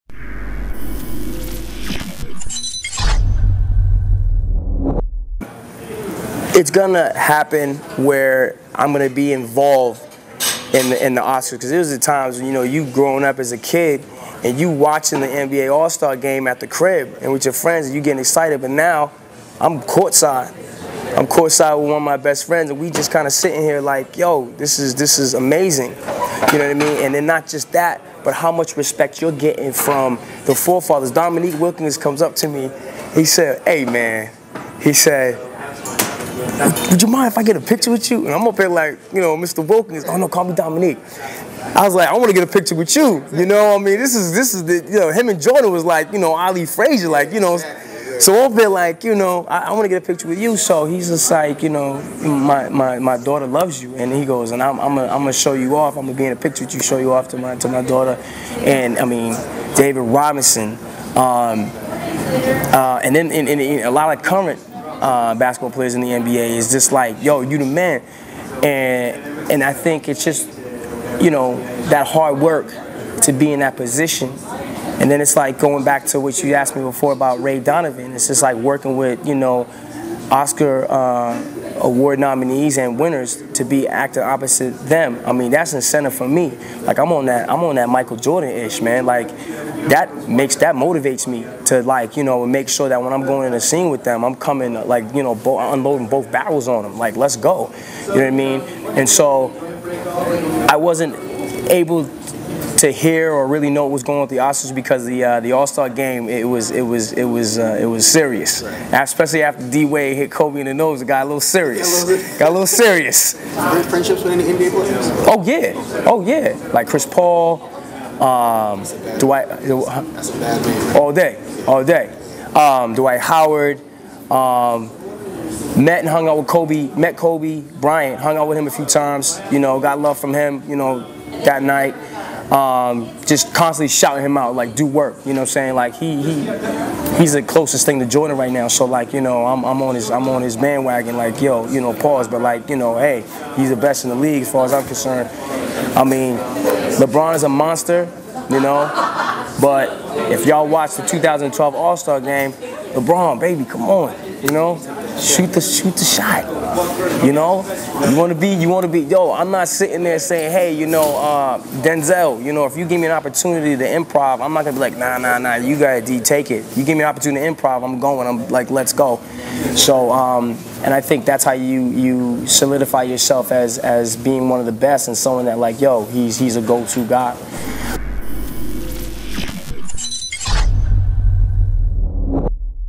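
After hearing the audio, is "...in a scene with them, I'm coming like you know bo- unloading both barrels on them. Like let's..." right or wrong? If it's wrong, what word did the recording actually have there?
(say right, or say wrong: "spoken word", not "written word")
right.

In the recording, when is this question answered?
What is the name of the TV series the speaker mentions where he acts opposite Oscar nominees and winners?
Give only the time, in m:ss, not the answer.
1:17.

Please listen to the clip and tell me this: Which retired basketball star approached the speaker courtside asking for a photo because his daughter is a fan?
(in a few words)
Dominique Wilkins.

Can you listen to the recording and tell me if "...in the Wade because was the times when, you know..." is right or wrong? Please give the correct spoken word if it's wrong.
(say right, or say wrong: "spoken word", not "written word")
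wrong: "Oscars", not "Wade".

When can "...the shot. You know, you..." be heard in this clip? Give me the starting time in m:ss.
2:35.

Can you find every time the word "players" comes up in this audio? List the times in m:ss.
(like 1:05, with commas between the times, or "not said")
1:05, 1:54.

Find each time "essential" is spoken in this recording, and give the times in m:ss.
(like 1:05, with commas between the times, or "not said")
not said.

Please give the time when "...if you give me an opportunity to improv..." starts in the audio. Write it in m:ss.
2:42.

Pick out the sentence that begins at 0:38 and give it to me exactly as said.
And I'm up there like, you know, Mr.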